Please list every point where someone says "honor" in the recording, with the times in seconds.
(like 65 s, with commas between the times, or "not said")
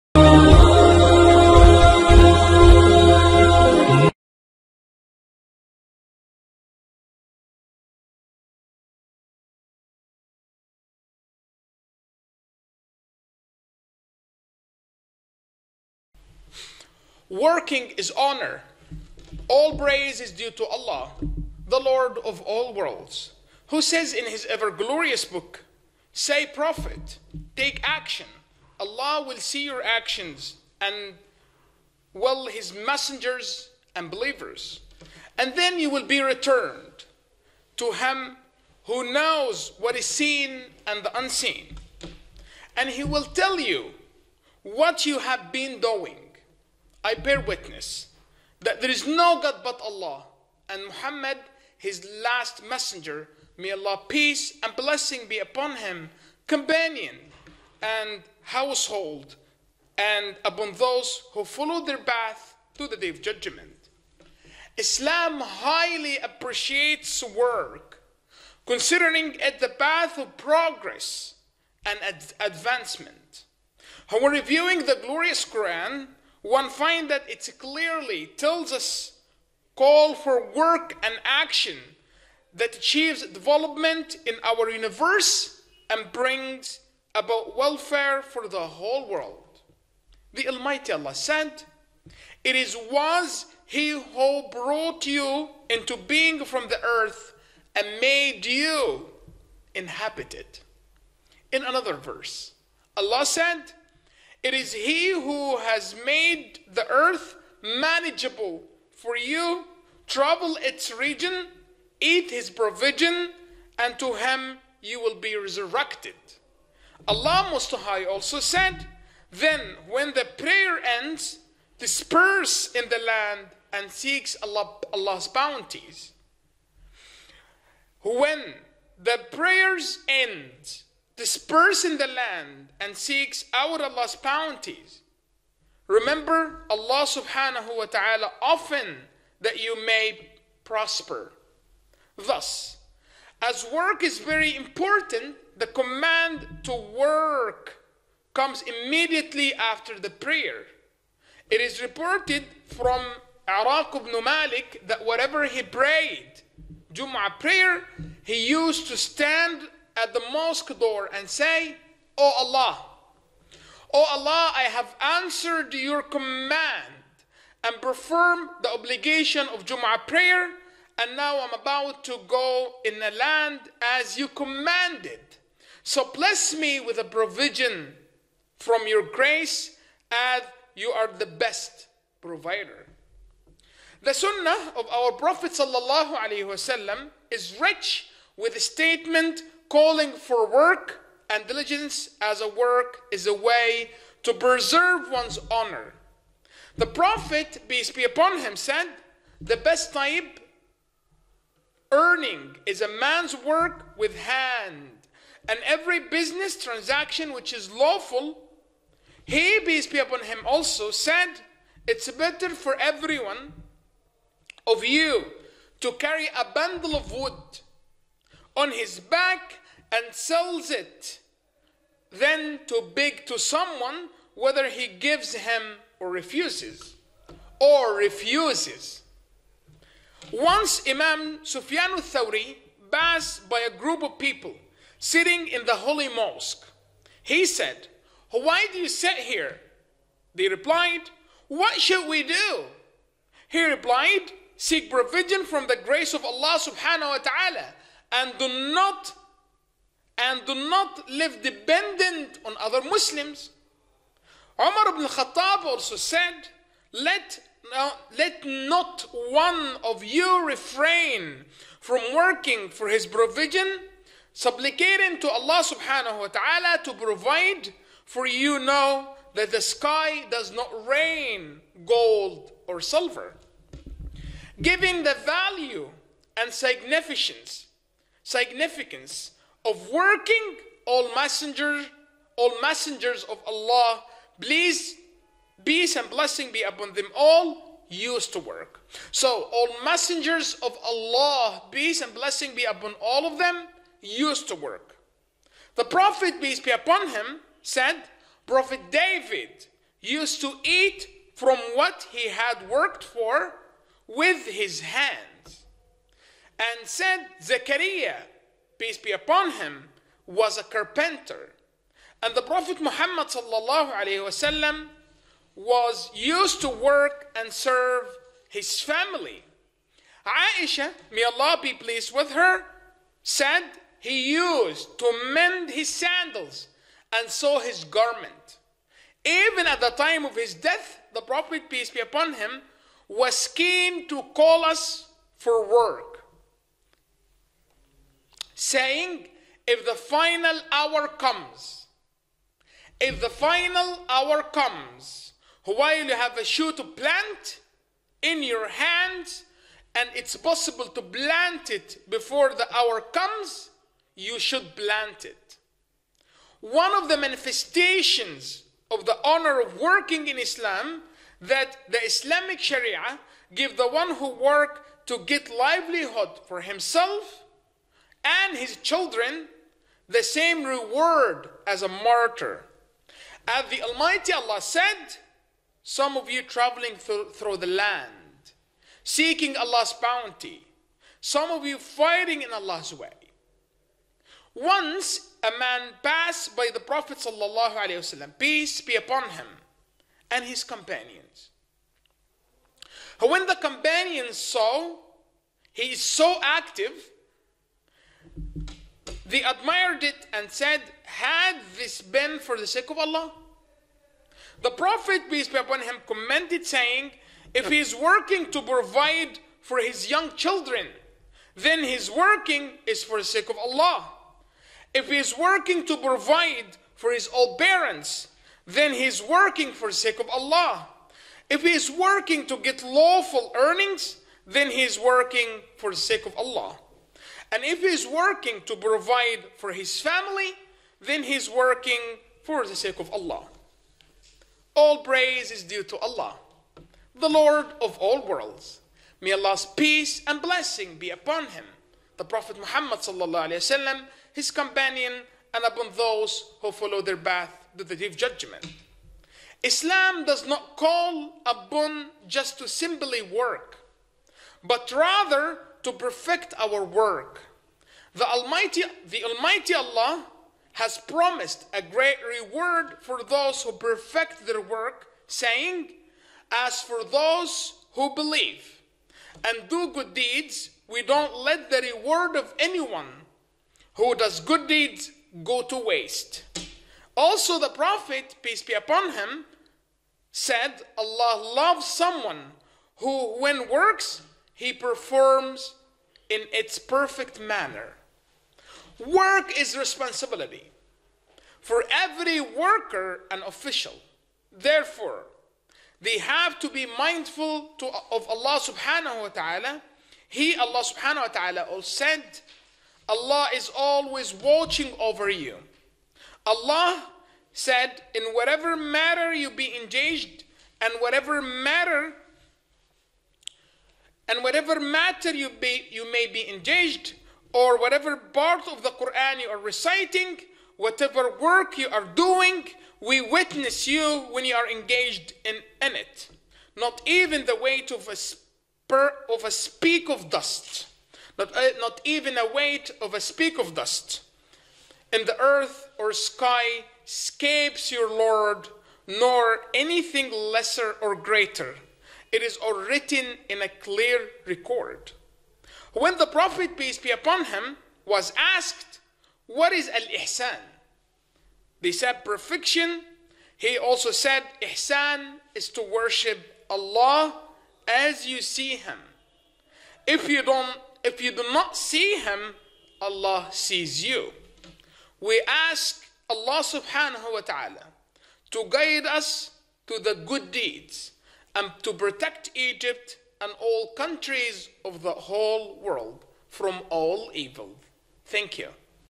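18 s, 195 s, 359 s.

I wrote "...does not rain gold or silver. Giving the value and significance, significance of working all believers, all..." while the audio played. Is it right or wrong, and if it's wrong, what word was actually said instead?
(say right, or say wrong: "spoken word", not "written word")
wrong: "messengers", not "believers".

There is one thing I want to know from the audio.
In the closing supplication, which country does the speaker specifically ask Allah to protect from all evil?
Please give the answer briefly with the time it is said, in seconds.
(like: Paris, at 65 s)
Egypt, at 572 s.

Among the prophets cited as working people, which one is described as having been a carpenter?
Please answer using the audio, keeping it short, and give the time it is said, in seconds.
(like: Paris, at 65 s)
Zechariah, at 307 s.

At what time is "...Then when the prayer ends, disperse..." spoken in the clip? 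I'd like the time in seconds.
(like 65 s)
119 s.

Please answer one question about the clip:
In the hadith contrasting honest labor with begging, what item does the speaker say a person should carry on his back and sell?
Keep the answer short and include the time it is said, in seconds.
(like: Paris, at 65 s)
A bundle of wood, at 216 s.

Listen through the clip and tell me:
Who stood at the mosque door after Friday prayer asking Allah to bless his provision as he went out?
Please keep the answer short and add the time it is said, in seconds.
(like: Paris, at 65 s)
Araq ibn Malik, at 153 s.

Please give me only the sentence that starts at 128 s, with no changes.
When the prayers end, disperse in the land and seeks out Allah's bounties.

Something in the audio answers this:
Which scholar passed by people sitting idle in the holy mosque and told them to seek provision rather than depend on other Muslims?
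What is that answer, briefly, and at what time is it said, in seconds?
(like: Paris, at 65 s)
Sufyan al-Thawri, at 231 s.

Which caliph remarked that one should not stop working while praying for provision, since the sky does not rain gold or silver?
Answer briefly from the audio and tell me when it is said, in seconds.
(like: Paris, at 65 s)
Umar ibn Khattab, at 254 s.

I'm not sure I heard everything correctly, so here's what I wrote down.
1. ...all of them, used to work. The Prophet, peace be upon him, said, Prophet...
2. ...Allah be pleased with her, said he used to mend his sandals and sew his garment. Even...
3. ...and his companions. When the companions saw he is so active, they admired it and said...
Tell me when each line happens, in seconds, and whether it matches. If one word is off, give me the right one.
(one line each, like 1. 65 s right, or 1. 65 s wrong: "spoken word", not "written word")
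1. 293 s right
2. 321 s right
3. 390 s right.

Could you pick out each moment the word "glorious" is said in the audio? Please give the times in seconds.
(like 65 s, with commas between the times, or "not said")
24 s, 75 s.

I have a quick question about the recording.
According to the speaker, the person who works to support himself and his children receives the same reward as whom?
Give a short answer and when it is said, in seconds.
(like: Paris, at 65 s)
A martyr, at 371 s.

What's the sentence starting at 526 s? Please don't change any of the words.
Not even the weight of a, spur, of a speak of dust.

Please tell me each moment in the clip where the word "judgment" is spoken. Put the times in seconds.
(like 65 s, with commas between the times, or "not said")
63 s, 448 s.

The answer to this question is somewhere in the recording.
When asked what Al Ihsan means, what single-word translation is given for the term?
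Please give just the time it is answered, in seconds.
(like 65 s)
552 s.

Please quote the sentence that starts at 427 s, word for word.
And if he's working to provide for his family, then he's working for the sake of Allah.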